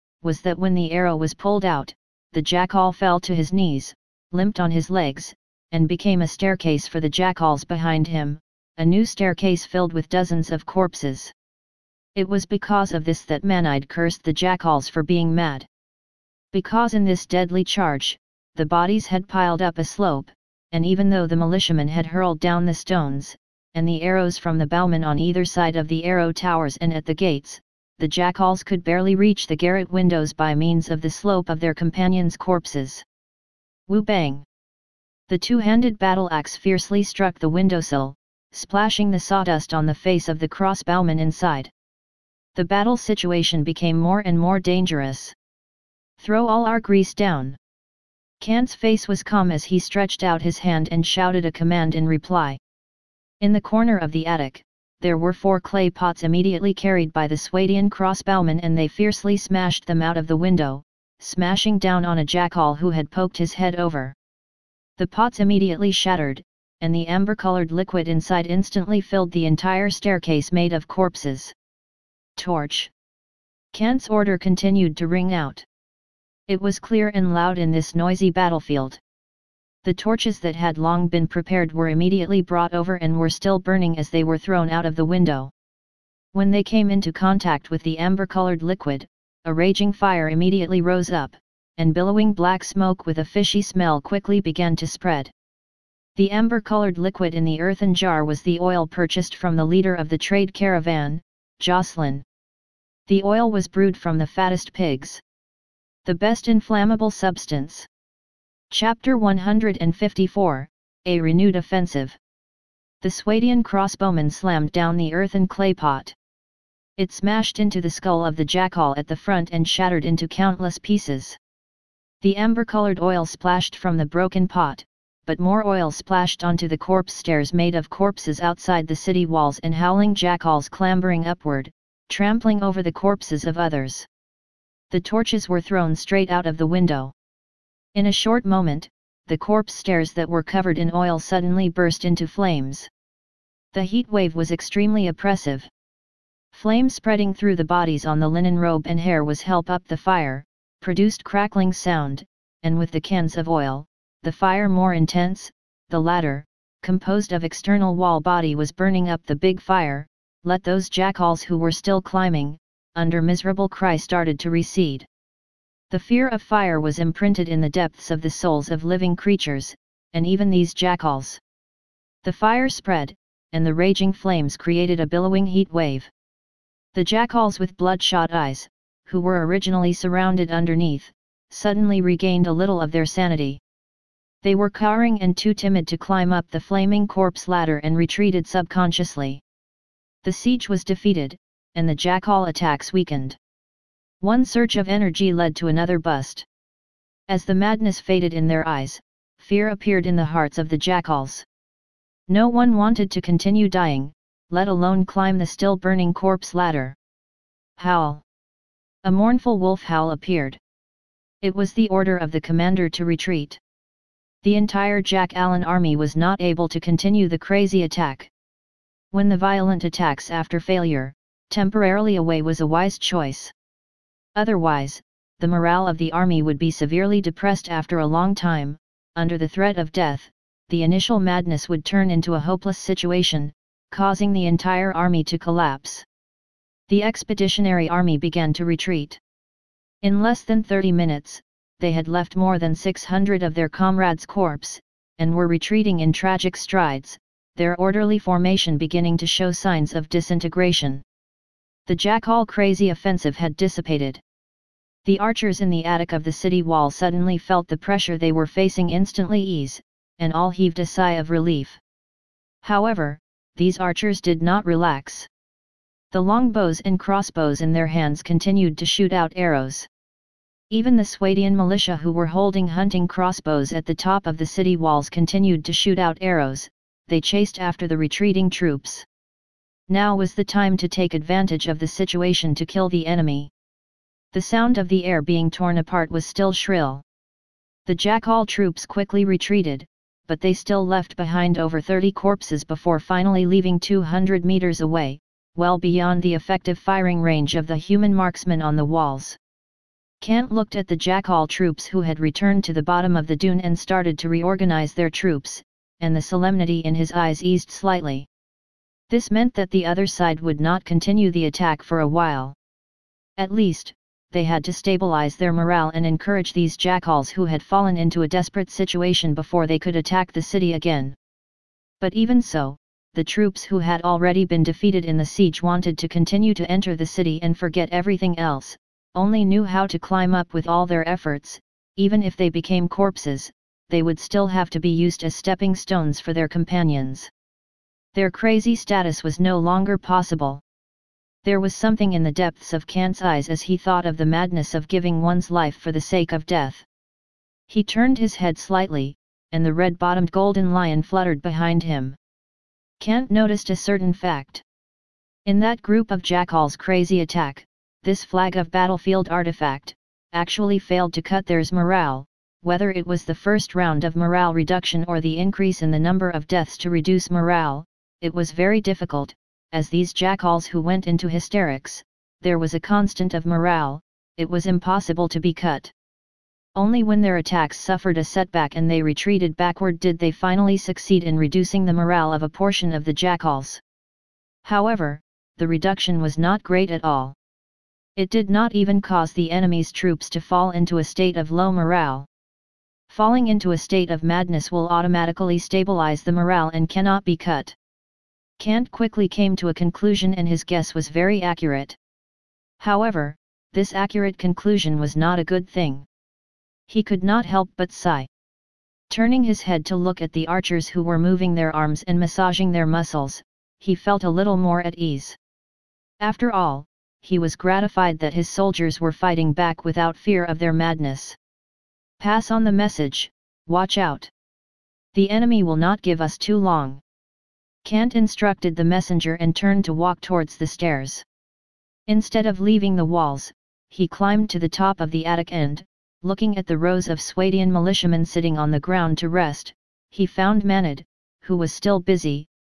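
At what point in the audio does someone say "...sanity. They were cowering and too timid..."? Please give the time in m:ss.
3:03.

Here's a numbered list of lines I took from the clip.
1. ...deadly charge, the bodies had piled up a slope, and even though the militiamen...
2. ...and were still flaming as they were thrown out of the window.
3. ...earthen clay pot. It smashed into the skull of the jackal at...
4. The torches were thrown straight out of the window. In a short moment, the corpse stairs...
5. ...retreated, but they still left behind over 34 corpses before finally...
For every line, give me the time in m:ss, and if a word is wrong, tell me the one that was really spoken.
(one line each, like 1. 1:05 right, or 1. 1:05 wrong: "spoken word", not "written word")
1. 0:17 right
2. 1:22 wrong: "burning", not "flaming"
3. 1:55 right
4. 2:14 right
5. 4:49 wrong: "30", not "34".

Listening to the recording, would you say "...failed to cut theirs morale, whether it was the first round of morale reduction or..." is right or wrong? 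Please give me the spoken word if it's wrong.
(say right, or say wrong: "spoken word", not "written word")
right.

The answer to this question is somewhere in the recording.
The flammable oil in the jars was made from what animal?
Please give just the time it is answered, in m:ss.
1:44.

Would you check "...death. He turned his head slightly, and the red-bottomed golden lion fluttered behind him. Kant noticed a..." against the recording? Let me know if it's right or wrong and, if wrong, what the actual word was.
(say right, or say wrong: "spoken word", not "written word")
right.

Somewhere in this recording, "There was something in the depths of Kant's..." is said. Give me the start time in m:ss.
5:41.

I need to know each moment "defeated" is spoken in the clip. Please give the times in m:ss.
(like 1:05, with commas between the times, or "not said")
3:10, 5:24.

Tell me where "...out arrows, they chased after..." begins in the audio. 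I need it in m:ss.
4:35.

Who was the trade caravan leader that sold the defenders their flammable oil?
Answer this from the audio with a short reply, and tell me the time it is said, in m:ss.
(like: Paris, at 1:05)
Jocelyn, at 1:41.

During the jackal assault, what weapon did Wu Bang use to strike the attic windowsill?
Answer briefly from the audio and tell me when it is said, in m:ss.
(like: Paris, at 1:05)
Two-handed battle axe, at 0:35.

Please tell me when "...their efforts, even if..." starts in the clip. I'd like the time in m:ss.
5:30.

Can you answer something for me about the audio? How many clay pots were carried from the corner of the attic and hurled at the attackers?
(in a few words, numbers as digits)
4.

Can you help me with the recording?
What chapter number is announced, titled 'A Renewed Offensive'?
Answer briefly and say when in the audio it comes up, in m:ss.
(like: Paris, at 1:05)
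154, at 1:49.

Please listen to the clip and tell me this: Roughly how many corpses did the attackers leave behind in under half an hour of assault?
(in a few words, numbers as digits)
600.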